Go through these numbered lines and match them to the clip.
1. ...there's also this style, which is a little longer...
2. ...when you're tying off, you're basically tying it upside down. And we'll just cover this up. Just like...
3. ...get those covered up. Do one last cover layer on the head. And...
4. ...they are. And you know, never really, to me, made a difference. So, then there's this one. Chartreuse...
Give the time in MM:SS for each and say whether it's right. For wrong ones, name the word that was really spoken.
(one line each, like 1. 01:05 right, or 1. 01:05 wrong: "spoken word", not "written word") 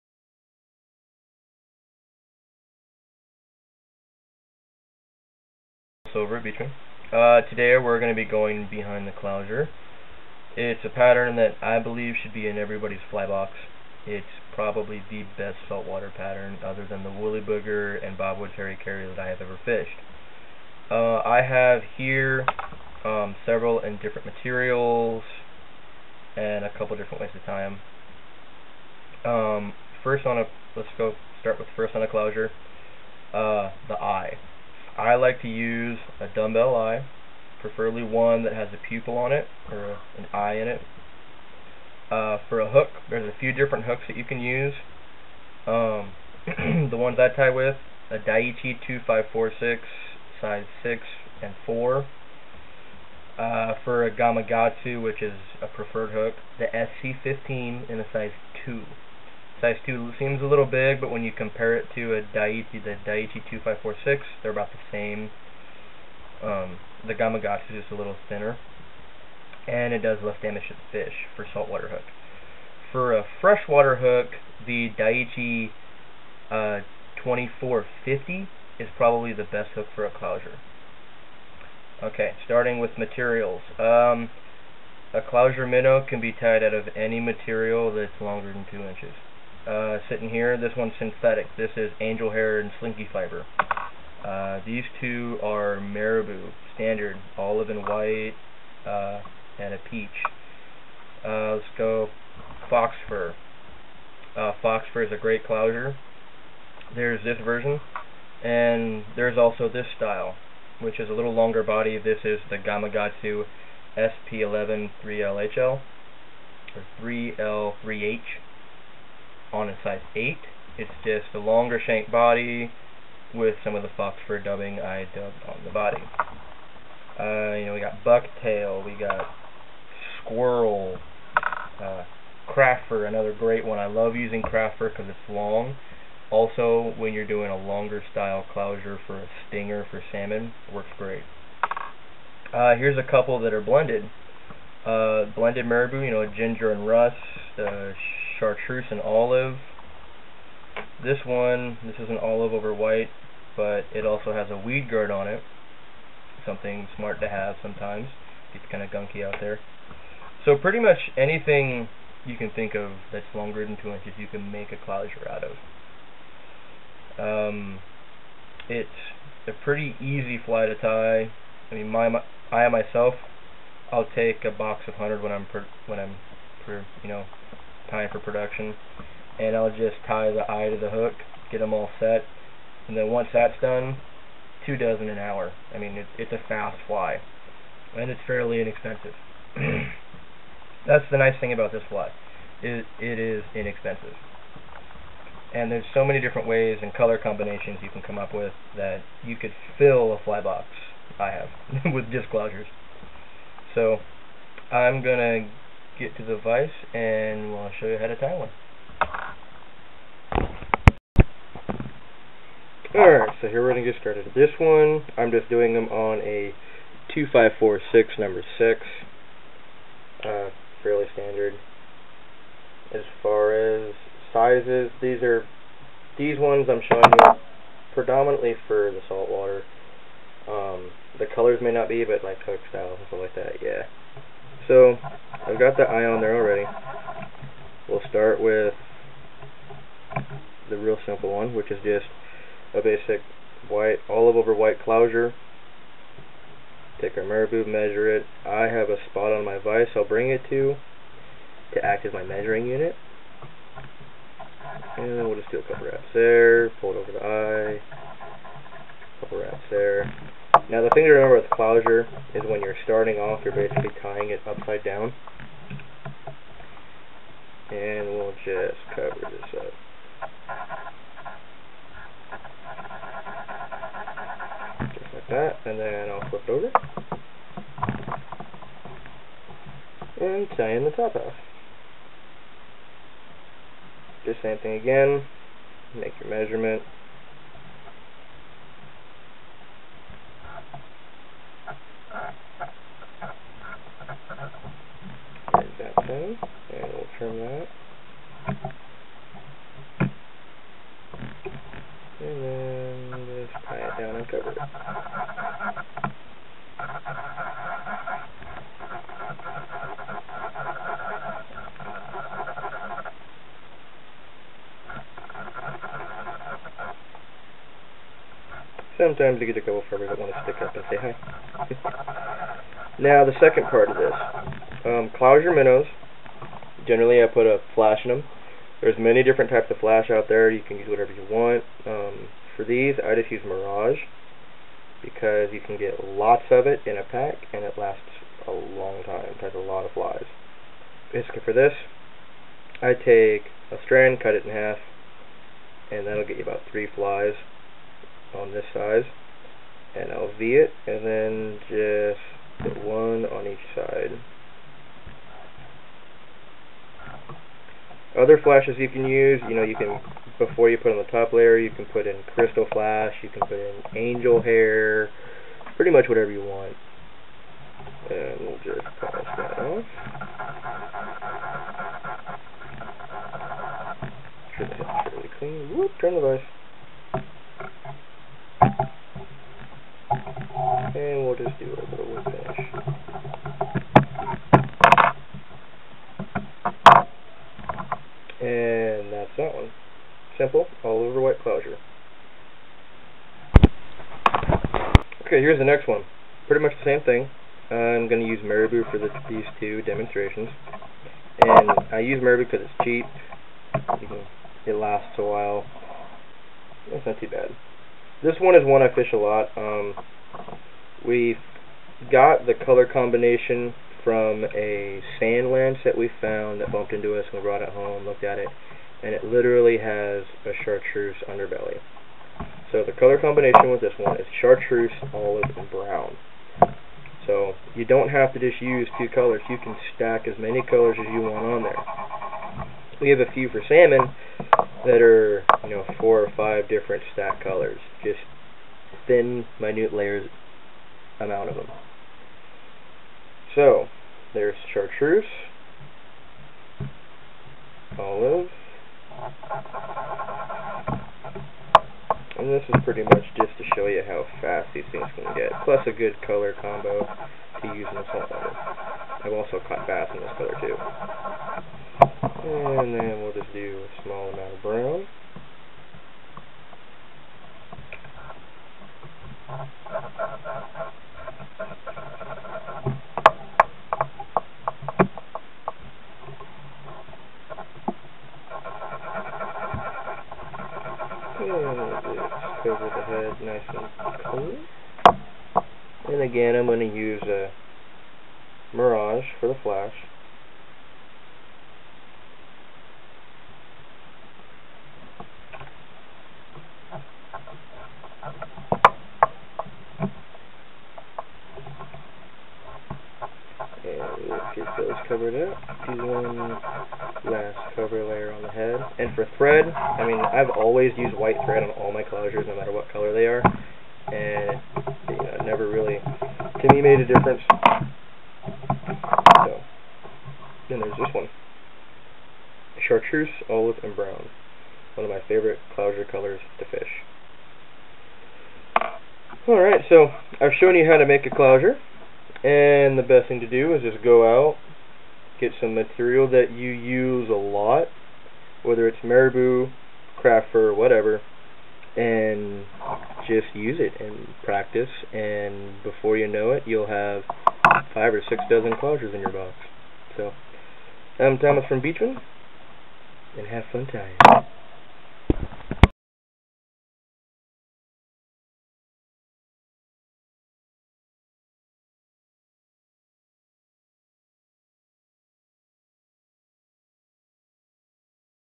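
1. 01:49 right
2. 04:22 wrong: "starting", not "tying"
3. 08:24 right
4. 08:33 right.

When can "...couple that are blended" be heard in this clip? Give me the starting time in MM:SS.
02:23.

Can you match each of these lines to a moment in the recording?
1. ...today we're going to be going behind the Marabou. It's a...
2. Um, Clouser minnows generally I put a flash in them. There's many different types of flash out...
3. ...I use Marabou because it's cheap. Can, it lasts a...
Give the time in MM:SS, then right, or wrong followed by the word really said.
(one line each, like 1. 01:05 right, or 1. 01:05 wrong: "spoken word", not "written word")
1. 00:07 wrong: "Clouser", not "Marabou"
2. 05:24 right
3. 06:41 right.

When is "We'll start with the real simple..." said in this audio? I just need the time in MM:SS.
03:57.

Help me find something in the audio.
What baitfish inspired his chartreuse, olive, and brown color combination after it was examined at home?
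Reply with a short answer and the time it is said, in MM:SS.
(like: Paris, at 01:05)
sand lance, at 06:55.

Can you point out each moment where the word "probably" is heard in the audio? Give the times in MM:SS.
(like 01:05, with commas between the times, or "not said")
00:14, 01:18.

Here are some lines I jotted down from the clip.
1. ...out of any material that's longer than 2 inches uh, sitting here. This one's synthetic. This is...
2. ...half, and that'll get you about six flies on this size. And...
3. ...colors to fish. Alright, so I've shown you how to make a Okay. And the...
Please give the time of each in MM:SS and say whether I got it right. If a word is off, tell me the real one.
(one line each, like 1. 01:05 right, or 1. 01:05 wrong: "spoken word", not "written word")
1. 01:26 right
2. 05:44 wrong: "three", not "six"
3. 08:46 wrong: "Clouser", not "Okay".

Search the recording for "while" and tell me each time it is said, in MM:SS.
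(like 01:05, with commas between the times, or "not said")
06:45.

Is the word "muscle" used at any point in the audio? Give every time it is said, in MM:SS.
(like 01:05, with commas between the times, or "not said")
not said.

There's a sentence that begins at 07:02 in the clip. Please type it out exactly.
So the color combination with this one is chartreuse, olive, and brown.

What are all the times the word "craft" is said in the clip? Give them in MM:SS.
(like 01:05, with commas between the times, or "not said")
02:14, 09:00.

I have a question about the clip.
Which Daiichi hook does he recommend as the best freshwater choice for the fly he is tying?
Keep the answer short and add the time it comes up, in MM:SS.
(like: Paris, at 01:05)
2450, at 01:17.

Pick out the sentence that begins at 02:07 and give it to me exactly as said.
Uh, you know, we got bucktail, we got squirrel, uh, another great one.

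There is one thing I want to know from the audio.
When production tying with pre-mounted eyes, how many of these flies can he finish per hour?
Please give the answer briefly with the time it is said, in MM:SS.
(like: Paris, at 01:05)
two dozen, at 03:04.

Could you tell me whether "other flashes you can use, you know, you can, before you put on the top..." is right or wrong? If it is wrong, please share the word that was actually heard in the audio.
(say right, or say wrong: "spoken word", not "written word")
right.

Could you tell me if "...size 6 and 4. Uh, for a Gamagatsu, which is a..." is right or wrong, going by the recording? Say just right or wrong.
right.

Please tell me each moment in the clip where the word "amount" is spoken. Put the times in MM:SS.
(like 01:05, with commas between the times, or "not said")
07:21, 07:44.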